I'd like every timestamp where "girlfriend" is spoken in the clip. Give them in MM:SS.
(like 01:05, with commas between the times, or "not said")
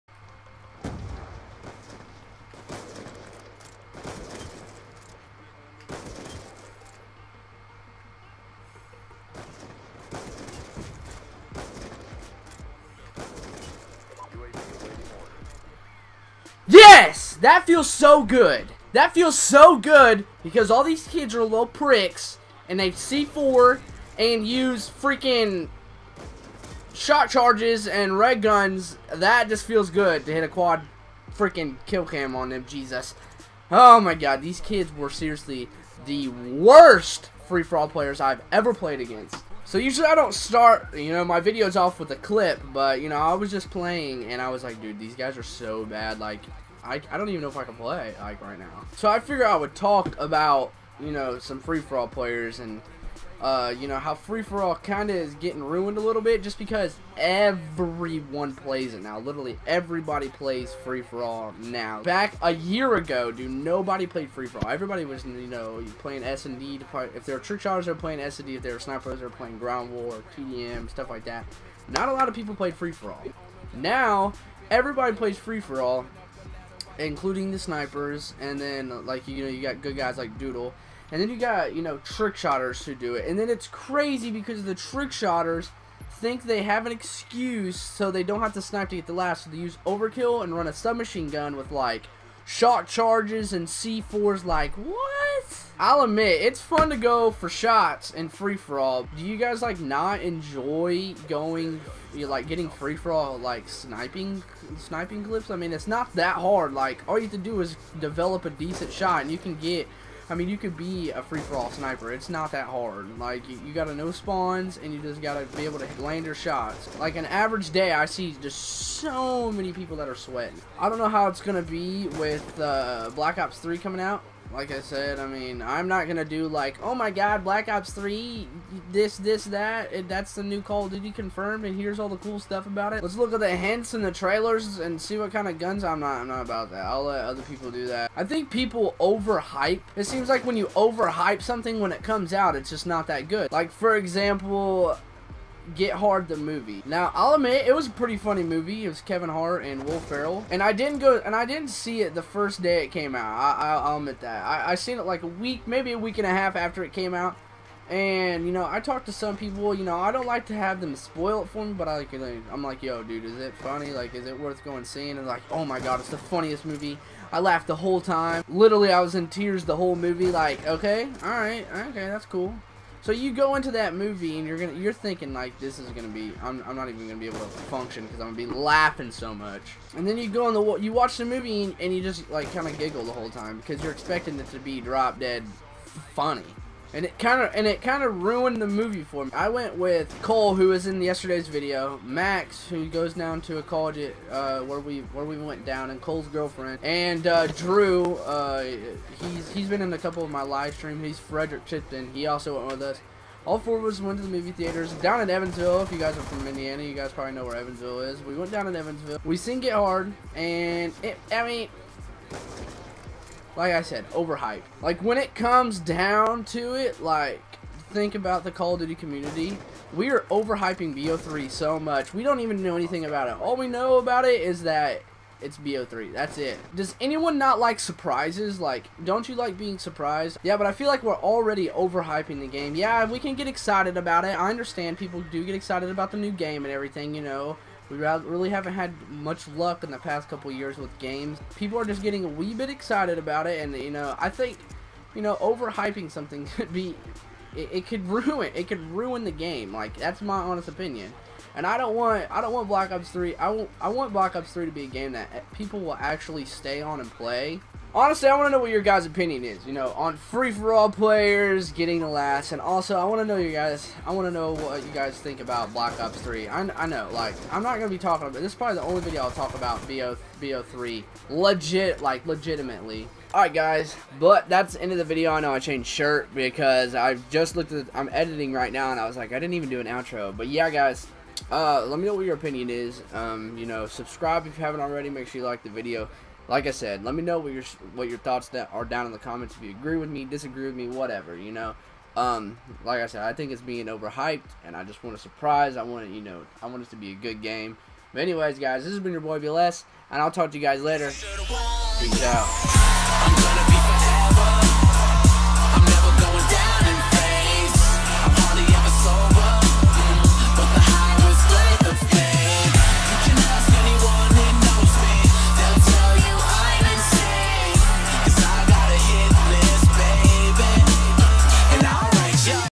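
03:16.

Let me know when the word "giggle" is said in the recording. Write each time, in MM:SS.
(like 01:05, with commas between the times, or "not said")
03:02.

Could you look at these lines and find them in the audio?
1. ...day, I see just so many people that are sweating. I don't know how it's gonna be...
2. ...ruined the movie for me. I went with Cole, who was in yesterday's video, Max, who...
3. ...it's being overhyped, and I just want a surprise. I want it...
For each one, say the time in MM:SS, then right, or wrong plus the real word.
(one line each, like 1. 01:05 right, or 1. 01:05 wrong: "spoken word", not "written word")
1. 01:57 right
2. 03:08 right
3. 04:53 right.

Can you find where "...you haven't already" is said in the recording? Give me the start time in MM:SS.
04:44.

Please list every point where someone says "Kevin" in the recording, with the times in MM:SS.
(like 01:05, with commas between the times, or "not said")
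02:29.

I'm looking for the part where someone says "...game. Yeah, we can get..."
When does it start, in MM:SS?
03:52.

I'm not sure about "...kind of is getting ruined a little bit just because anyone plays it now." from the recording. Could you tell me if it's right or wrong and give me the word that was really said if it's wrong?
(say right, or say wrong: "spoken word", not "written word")
wrong: "everyone", not "anyone".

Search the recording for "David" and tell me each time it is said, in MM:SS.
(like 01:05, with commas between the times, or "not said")
not said.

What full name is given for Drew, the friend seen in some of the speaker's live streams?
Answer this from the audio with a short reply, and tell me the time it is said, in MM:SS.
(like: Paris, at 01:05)
Frederick Chipton, at 03:21.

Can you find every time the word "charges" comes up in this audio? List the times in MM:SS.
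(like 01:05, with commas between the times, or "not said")
00:27, 01:32.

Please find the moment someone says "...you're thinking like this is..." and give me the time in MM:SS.
02:54.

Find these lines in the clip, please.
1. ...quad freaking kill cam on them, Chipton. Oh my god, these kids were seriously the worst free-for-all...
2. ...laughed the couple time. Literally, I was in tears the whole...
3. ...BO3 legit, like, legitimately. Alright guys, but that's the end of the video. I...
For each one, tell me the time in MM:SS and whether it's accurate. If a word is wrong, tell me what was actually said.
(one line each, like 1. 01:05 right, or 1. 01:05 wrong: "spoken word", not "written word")
1. 00:30 wrong: "Jesus", not "Chipton"
2. 02:47 wrong: "whole", not "couple"
3. 04:30 right.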